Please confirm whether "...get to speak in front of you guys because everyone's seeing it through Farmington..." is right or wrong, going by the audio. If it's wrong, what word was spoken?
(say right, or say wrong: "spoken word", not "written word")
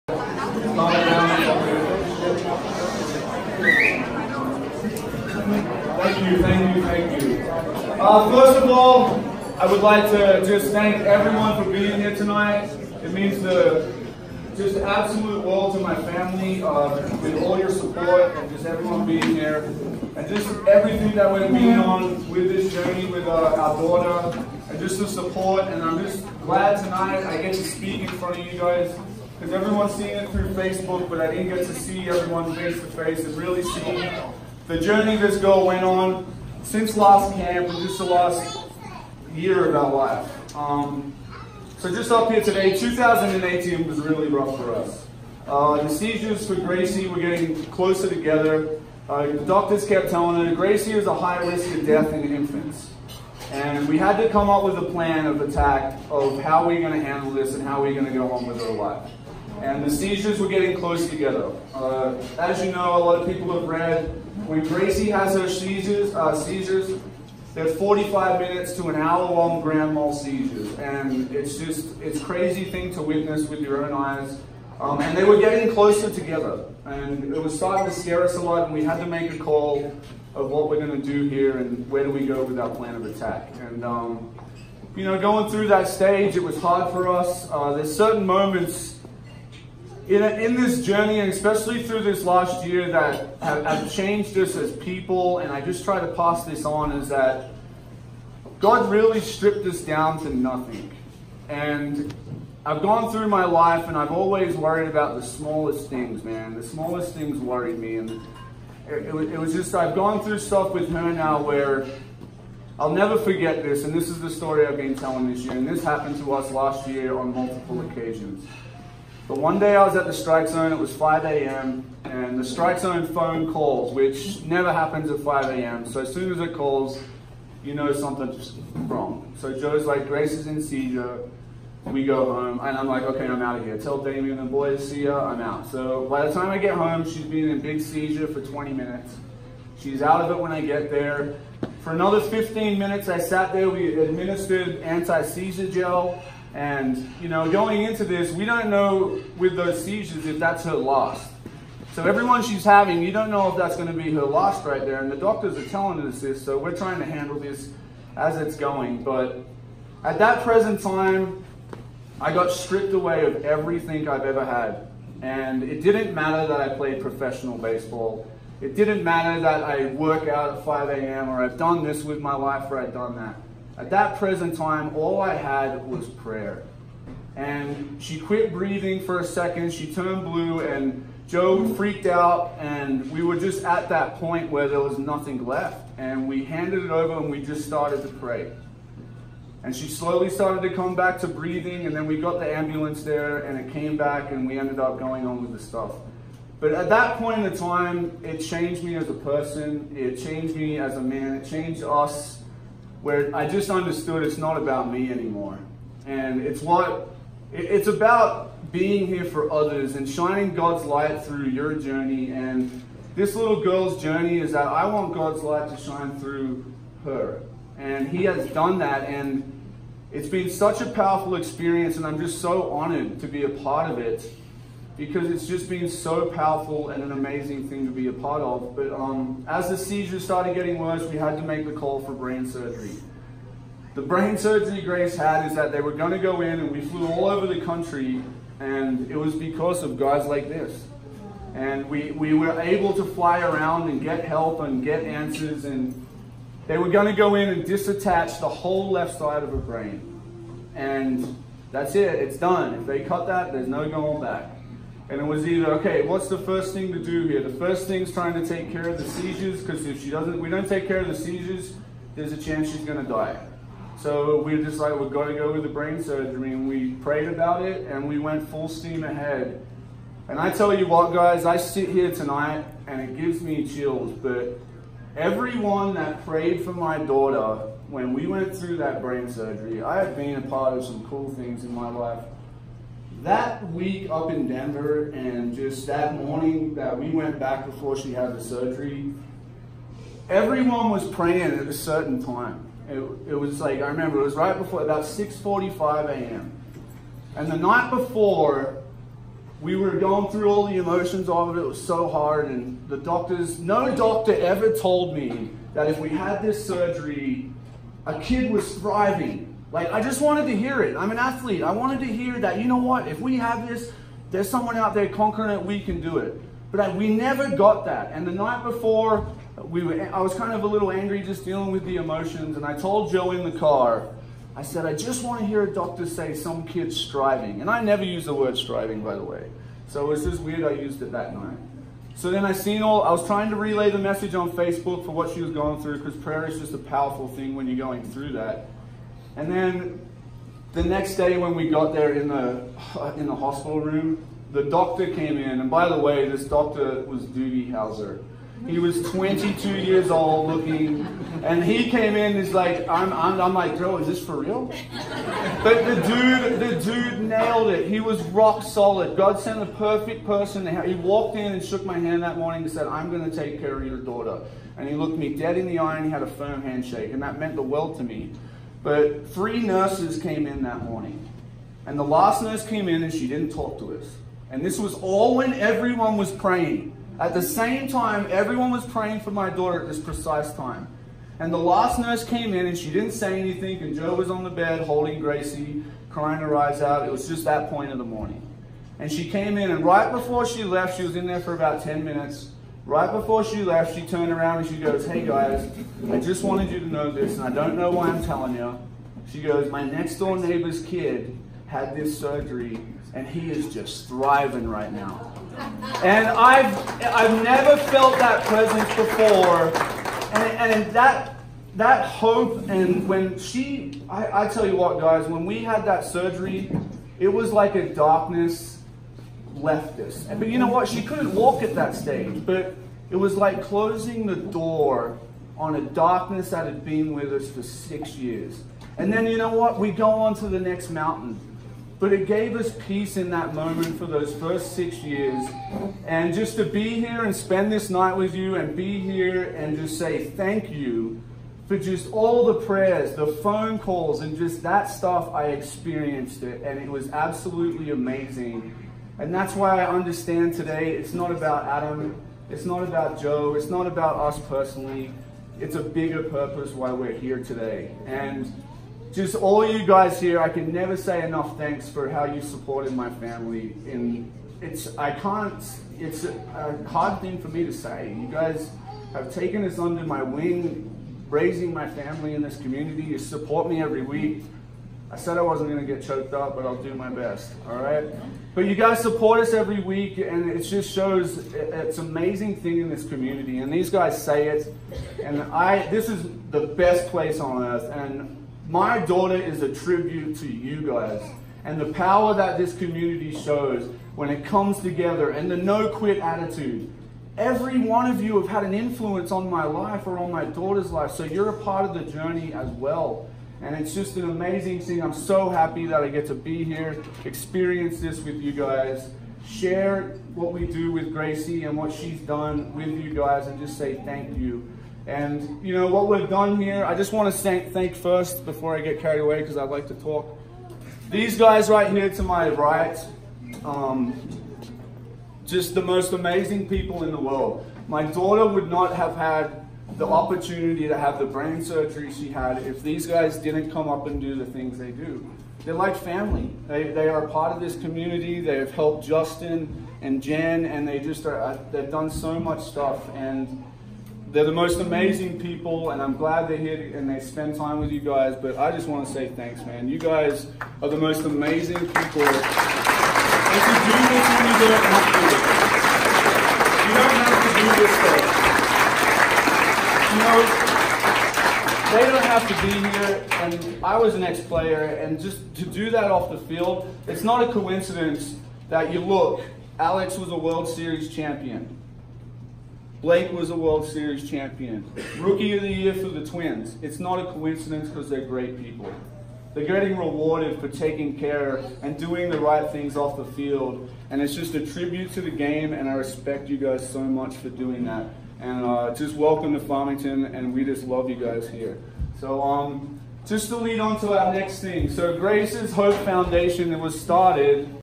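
wrong: "Facebook", not "Farmington".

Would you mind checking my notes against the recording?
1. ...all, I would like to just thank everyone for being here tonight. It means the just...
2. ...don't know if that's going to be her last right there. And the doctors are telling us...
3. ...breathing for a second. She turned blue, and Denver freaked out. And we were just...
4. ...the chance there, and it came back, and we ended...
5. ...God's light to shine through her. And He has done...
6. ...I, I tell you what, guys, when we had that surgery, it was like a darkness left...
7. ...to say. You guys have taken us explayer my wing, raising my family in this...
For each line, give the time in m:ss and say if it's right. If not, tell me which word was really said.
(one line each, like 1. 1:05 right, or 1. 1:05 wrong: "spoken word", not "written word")
1. 0:08 right
2. 2:33 right
3. 2:58 wrong: "Joe", not "Denver"
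4. 3:12 wrong: "ambulance", not "chance"
5. 3:35 right
6. 6:54 right
7. 7:47 wrong: "under", not "explayer".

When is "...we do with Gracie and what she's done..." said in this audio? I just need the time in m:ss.
8:30.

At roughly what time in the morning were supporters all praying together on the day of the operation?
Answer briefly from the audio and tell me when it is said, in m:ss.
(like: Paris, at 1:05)
6:45 a.m., at 4:55.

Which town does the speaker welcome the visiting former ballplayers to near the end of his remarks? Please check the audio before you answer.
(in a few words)
Farmington.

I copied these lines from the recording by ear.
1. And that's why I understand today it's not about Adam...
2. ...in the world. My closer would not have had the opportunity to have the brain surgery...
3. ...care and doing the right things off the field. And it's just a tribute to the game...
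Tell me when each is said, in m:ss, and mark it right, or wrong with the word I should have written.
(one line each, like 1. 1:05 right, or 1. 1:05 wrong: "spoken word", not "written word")
1. 7:29 right
2. 8:47 wrong: "daughter", not "closer"
3. 9:41 right.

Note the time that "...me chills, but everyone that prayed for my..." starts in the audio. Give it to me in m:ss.
4:33.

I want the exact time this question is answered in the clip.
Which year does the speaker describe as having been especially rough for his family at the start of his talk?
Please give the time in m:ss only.
0:42.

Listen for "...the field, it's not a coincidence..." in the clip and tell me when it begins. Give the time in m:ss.
9:26.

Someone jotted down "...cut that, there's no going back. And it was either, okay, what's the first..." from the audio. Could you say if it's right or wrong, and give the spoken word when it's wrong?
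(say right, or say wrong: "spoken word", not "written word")
right.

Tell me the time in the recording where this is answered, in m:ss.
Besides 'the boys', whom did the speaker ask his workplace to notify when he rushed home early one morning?
2:14.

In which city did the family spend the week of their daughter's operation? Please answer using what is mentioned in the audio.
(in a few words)
Denver.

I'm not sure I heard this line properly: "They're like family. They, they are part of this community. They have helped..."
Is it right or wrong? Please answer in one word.
right.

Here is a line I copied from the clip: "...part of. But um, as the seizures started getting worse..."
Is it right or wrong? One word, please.
right.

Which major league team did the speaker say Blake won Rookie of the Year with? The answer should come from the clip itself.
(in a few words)
Twins.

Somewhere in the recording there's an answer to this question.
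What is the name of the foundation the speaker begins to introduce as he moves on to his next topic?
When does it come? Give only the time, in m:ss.
9:55.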